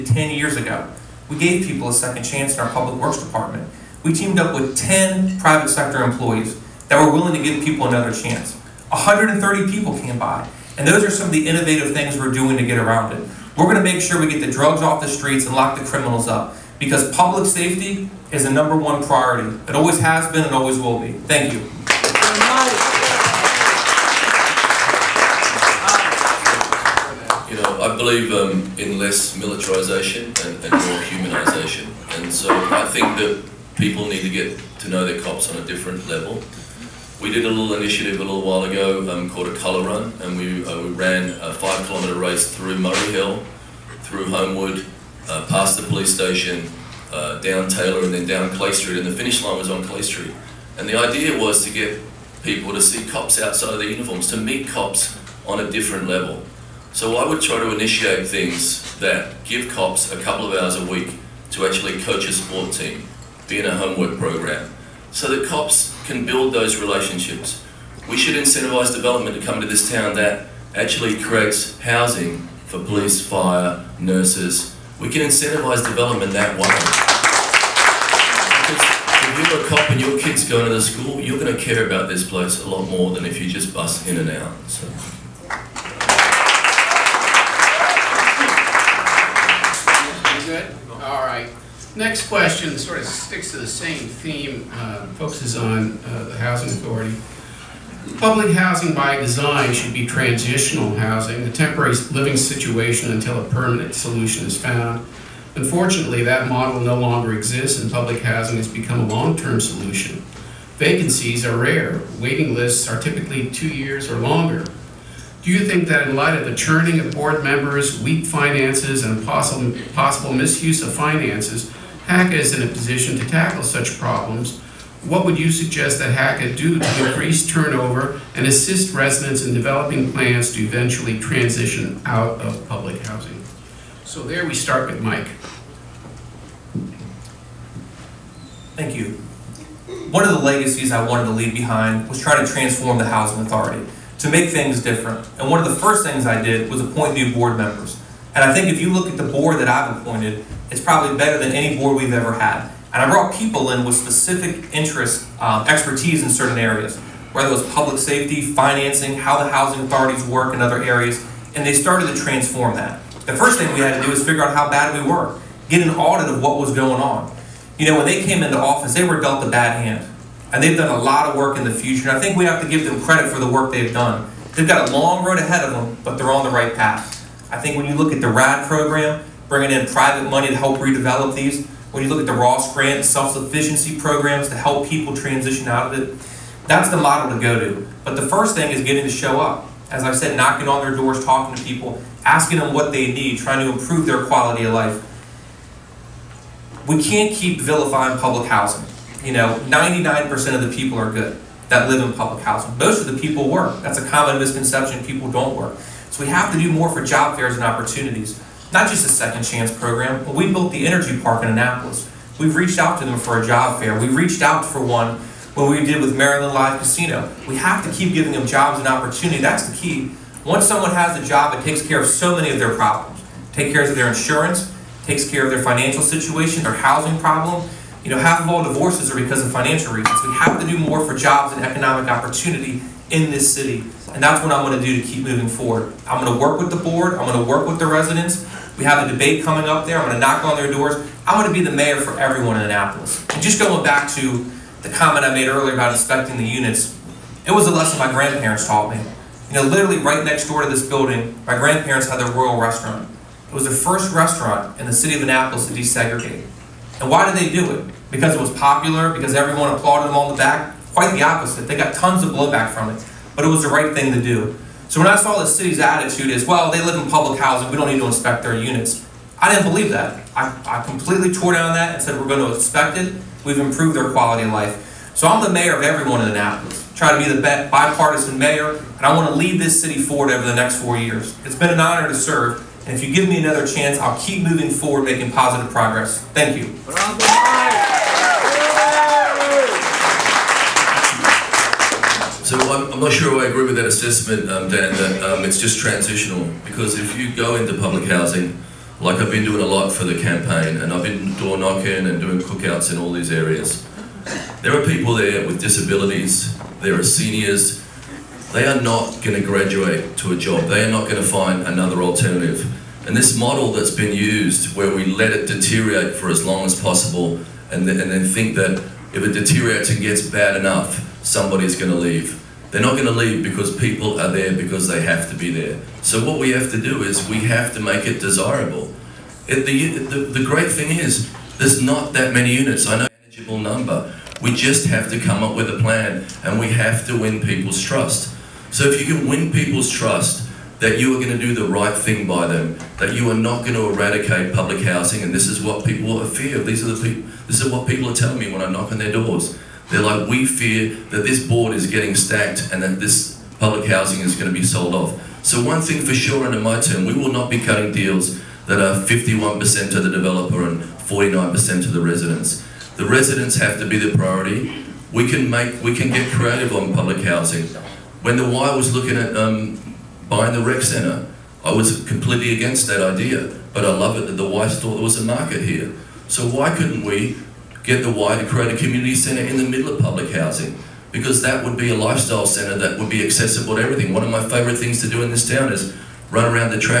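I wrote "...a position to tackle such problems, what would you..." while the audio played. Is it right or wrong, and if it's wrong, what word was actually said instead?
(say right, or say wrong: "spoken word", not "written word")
right.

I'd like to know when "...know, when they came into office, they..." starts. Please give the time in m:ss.
2:47.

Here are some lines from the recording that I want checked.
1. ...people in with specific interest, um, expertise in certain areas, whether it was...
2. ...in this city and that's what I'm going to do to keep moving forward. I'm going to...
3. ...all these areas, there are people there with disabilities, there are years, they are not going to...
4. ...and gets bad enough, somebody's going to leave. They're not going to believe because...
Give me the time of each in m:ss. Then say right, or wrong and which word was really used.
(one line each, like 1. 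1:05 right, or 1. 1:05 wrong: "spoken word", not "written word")
1. 2:33 right
2. 3:53 right
3. 5:02 wrong: "seniors", not "years"
4. 5:19 wrong: "leave", not "believe".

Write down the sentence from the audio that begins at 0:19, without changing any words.
It always has been and always will be.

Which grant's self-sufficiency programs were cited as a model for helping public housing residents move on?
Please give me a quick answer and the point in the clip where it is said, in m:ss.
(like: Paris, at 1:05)
Ross Grant, at 3:02.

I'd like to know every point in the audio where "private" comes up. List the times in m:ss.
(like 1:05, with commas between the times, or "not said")
0:05, 2:59.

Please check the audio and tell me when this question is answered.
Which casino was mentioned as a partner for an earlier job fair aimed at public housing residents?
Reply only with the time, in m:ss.
3:36.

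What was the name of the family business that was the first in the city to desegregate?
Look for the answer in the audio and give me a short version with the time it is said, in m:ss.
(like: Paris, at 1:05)
Royal Restaurant, at 4:12.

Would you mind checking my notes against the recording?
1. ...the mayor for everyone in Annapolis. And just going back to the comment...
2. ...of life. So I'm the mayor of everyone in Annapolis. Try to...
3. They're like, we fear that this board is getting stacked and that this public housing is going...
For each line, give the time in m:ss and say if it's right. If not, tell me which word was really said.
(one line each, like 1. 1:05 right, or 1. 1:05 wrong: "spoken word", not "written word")
1. 4:01 right
2. 4:34 right
3. 5:49 right.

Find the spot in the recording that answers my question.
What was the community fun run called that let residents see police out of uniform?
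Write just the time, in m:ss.
0:39.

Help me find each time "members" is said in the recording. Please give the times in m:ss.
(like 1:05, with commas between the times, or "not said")
1:57, 2:27.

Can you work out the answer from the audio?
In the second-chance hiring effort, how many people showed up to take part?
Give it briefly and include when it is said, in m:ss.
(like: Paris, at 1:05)
130, at 0:08.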